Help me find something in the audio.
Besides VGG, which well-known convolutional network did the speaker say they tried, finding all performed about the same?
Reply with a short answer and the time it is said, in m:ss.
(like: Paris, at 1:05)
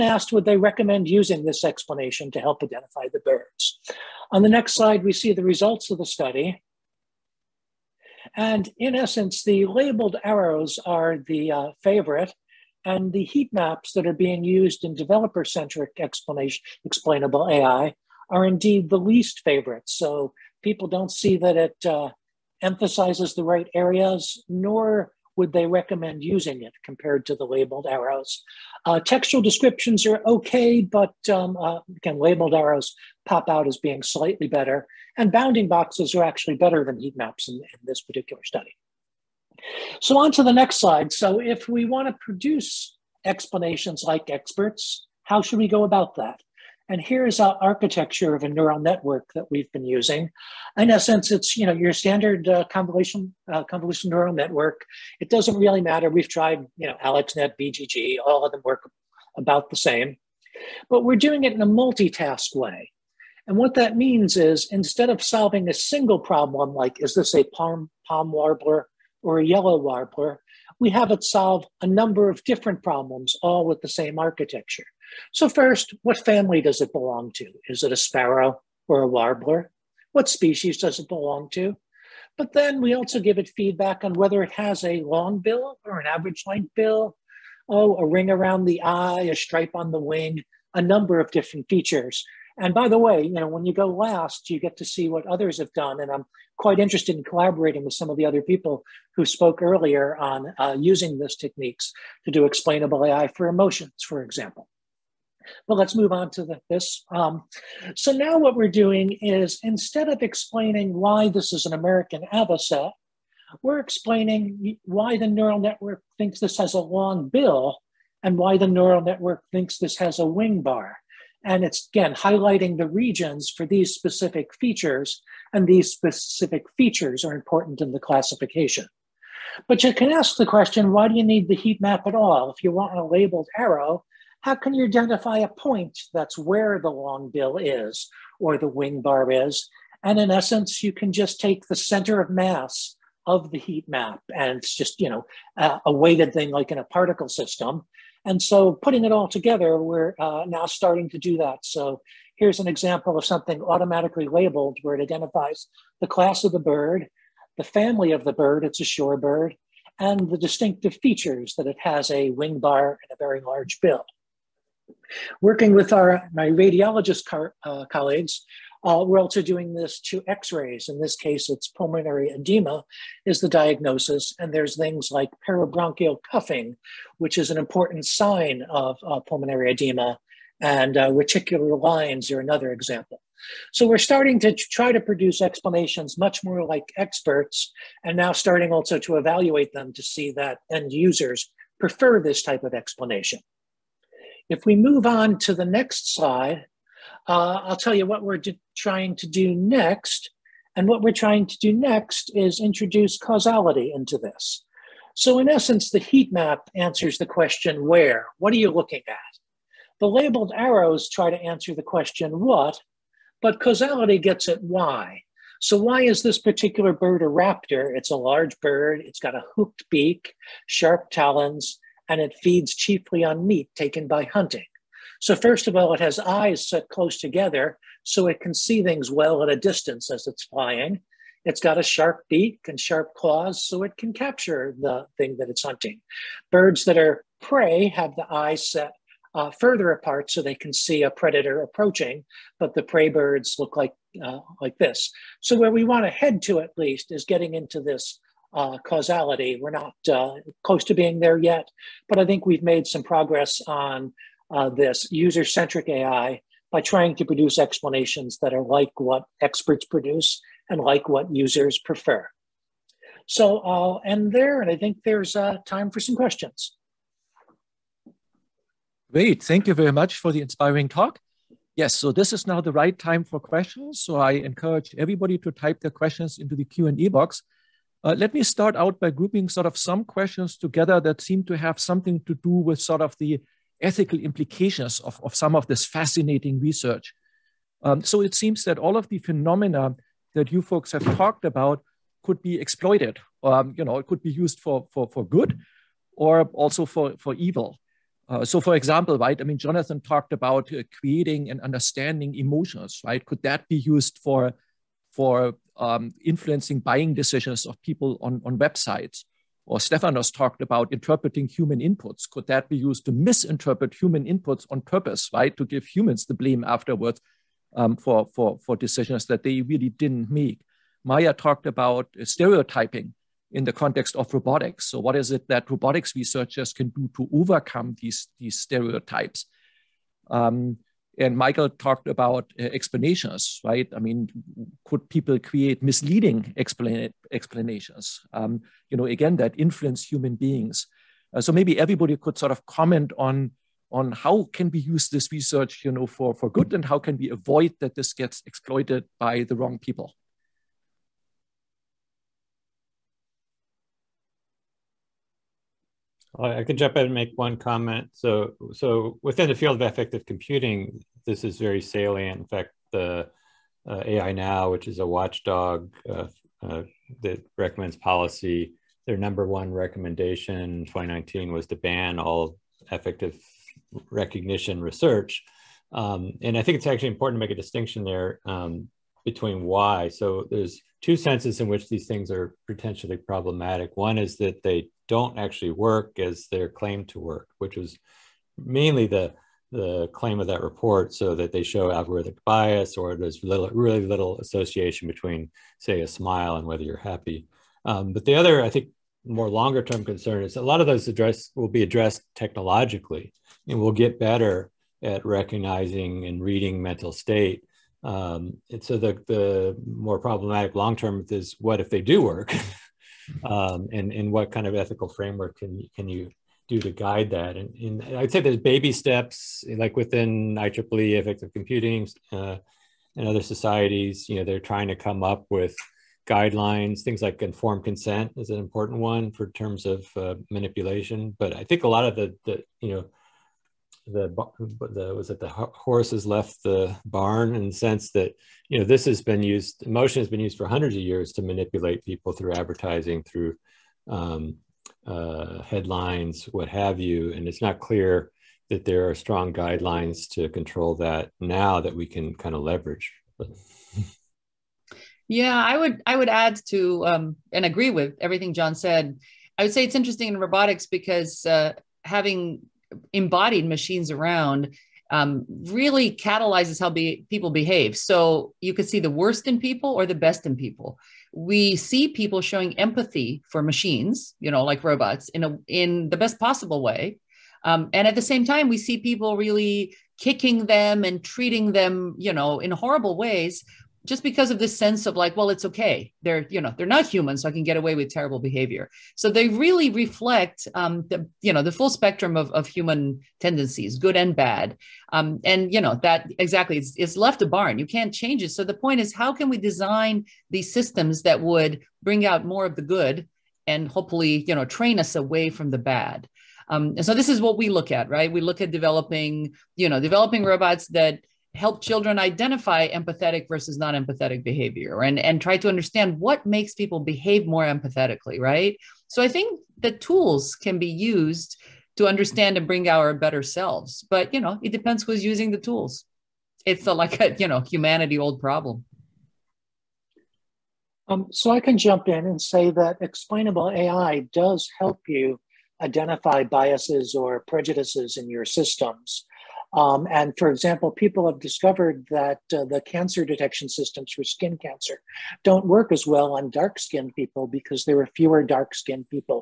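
AlexNet, at 0:57.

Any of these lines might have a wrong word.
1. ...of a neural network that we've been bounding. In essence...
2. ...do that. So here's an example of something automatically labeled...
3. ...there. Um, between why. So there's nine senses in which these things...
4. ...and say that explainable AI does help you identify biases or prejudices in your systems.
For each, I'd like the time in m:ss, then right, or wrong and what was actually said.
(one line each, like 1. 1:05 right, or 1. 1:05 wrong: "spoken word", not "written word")
1. 0:48 wrong: "using", not "bounding"
2. 2:31 right
3. 6:18 wrong: "two", not "nine"
4. 8:52 right.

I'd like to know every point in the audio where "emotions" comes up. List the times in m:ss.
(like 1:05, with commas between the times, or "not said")
1:43, 5:02, 7:19.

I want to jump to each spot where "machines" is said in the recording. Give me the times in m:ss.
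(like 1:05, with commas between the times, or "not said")
7:43, 7:53.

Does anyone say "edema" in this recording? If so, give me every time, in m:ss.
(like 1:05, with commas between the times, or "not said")
2:52, 2:59.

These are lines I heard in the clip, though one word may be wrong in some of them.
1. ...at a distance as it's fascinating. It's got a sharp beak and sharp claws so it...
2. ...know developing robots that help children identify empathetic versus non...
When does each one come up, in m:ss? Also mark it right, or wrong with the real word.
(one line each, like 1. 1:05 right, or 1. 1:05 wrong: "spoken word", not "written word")
1. 3:49 wrong: "flying", not "fascinating"
2. 8:29 right.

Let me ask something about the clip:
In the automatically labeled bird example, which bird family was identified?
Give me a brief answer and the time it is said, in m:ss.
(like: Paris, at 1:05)
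Shorebird, at 2:38.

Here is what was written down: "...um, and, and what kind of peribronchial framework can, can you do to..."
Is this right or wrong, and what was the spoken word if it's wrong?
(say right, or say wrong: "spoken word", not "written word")
wrong: "ethical", not "peribronchial".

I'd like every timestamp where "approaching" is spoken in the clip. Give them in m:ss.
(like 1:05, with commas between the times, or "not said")
4:01.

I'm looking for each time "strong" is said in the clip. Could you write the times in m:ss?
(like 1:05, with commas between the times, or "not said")
7:29.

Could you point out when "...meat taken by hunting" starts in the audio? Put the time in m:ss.
3:43.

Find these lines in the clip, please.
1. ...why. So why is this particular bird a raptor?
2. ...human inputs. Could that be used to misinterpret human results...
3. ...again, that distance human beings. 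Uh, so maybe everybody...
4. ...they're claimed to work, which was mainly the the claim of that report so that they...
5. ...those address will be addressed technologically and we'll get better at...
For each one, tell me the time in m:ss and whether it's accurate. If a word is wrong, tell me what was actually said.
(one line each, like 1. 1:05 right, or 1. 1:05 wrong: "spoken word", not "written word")
1. 3:34 right
2. 5:11 wrong: "inputs", not "results"
3. 5:39 wrong: "influence", not "distance"
4. 6:26 right
5. 6:40 right.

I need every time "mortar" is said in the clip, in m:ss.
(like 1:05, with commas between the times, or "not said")
not said.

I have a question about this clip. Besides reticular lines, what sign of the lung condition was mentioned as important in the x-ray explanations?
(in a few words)
Peribronchial cuffing.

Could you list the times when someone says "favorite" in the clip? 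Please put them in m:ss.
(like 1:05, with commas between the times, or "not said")
0:11, 0:19.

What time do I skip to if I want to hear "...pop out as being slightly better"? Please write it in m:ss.
0:33.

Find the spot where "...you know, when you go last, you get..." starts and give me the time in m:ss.
1:33.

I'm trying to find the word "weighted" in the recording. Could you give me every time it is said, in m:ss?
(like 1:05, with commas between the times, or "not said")
2:25.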